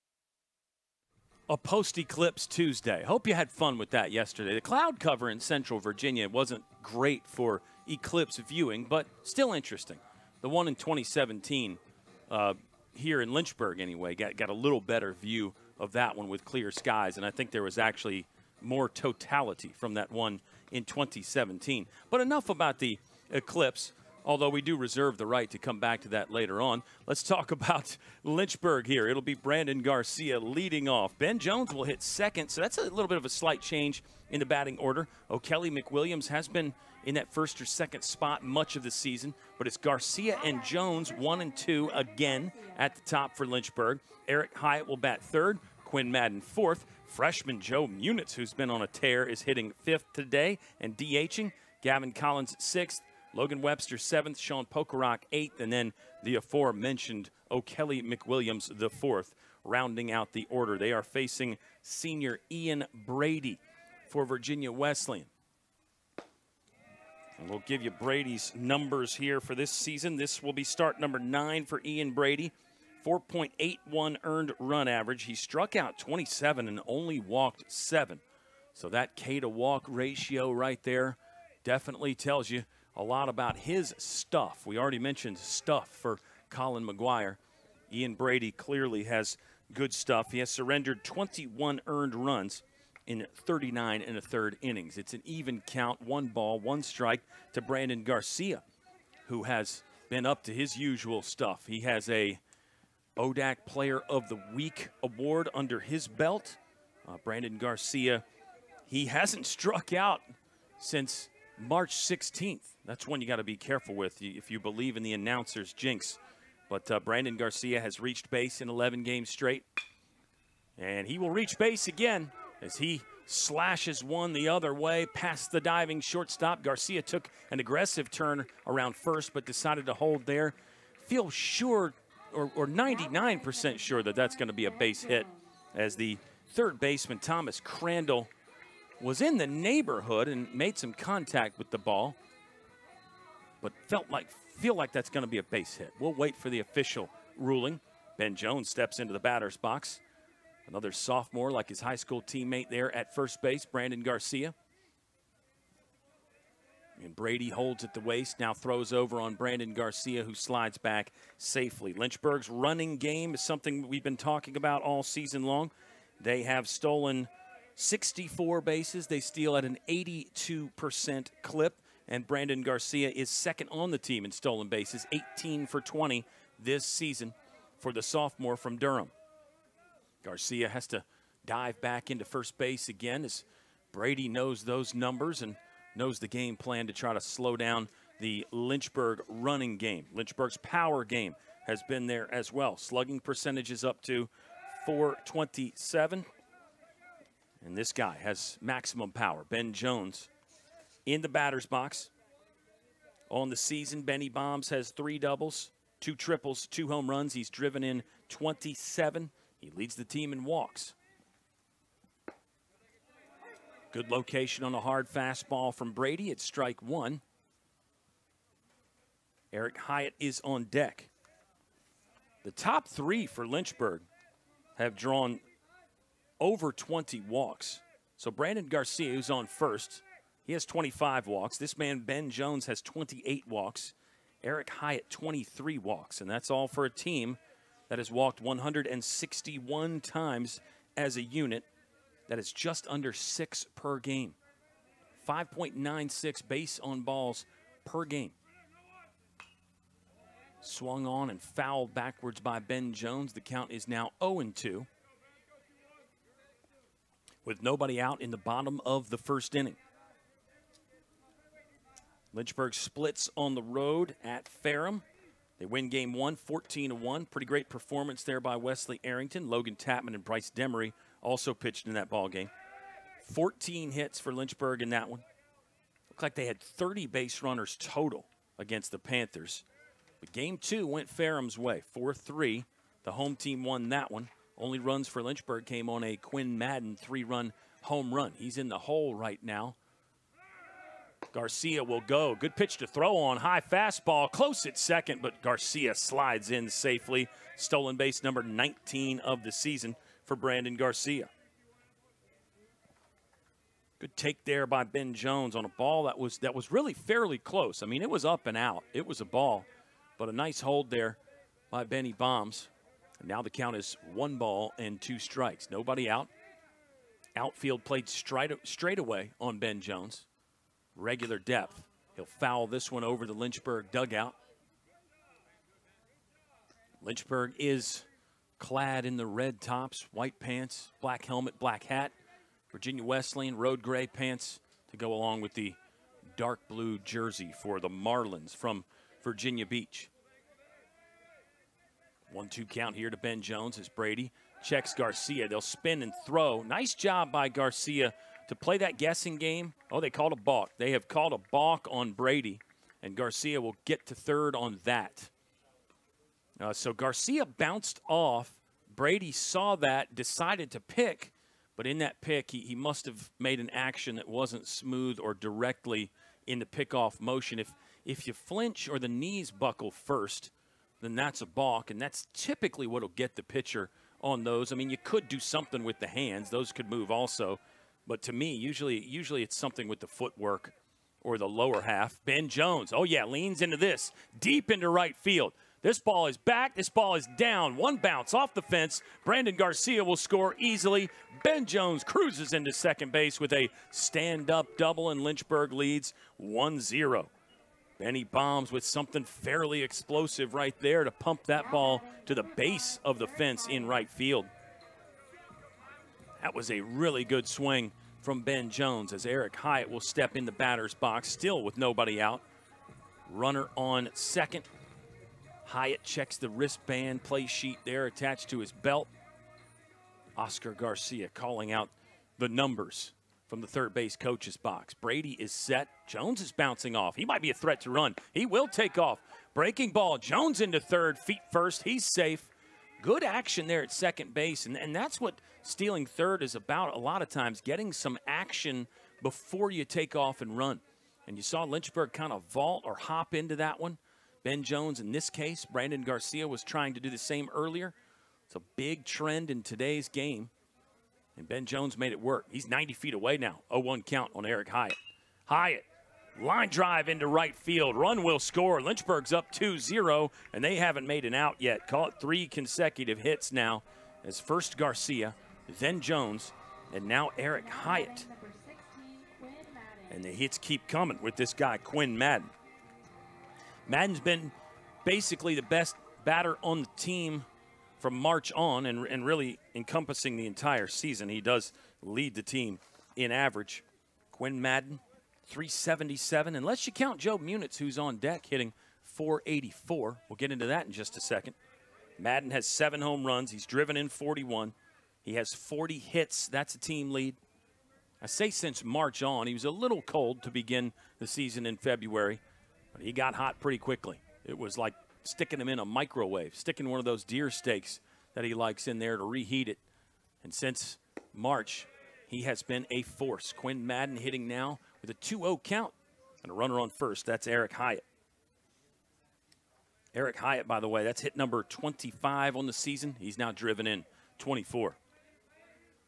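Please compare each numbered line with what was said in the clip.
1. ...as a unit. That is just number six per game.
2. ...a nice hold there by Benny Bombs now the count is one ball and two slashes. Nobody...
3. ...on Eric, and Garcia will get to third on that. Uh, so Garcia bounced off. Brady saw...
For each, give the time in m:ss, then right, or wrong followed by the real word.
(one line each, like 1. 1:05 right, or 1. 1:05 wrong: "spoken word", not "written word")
1. 4:00 wrong: "under", not "number"
2. 5:10 wrong: "strikes", not "slashes"
3. 5:51 wrong: "Brady", not "Eric".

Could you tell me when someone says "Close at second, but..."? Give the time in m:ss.
4:54.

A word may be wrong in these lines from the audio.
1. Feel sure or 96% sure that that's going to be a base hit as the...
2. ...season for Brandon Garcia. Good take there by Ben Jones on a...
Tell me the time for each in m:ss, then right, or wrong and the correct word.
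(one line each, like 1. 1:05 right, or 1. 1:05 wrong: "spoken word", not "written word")
1. 2:11 wrong: "99", not "96"
2. 4:59 right.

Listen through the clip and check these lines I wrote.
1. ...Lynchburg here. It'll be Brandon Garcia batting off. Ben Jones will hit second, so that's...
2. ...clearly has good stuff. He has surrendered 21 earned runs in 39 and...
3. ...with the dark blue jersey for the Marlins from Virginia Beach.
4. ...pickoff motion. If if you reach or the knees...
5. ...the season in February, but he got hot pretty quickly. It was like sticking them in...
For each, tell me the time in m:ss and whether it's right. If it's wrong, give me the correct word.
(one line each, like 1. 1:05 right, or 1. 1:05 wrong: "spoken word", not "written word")
1. 0:28 wrong: "leading", not "batting"
2. 1:28 right
3. 5:35 right
4. 6:06 wrong: "flinch", not "reach"
5. 8:21 right.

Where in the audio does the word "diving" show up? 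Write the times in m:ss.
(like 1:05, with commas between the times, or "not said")
2:05.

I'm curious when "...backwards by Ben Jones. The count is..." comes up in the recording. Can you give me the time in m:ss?
4:11.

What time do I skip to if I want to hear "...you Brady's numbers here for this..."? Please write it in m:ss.
1:07.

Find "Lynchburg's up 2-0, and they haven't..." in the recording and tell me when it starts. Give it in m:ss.
7:38.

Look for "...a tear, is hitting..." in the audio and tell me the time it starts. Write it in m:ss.
0:48.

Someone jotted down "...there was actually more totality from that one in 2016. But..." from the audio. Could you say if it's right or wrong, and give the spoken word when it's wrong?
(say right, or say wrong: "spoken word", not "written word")
wrong: "2017", not "2016".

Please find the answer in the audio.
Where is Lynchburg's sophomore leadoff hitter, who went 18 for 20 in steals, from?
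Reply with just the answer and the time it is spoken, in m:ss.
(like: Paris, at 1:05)
Durham, at 2:58.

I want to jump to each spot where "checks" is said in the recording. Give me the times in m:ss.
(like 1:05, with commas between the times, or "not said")
5:44, 6:56.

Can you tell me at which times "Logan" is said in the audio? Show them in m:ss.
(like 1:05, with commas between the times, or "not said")
0:53, 4:29.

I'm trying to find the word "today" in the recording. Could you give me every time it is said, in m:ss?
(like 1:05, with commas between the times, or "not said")
0:50, 7:29.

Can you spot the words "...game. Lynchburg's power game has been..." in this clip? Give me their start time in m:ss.
3:09.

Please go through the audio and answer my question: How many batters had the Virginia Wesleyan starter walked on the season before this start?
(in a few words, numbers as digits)
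7.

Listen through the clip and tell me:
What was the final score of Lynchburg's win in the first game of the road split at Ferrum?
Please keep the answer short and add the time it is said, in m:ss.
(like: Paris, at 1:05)
14 to 1, at 4:26.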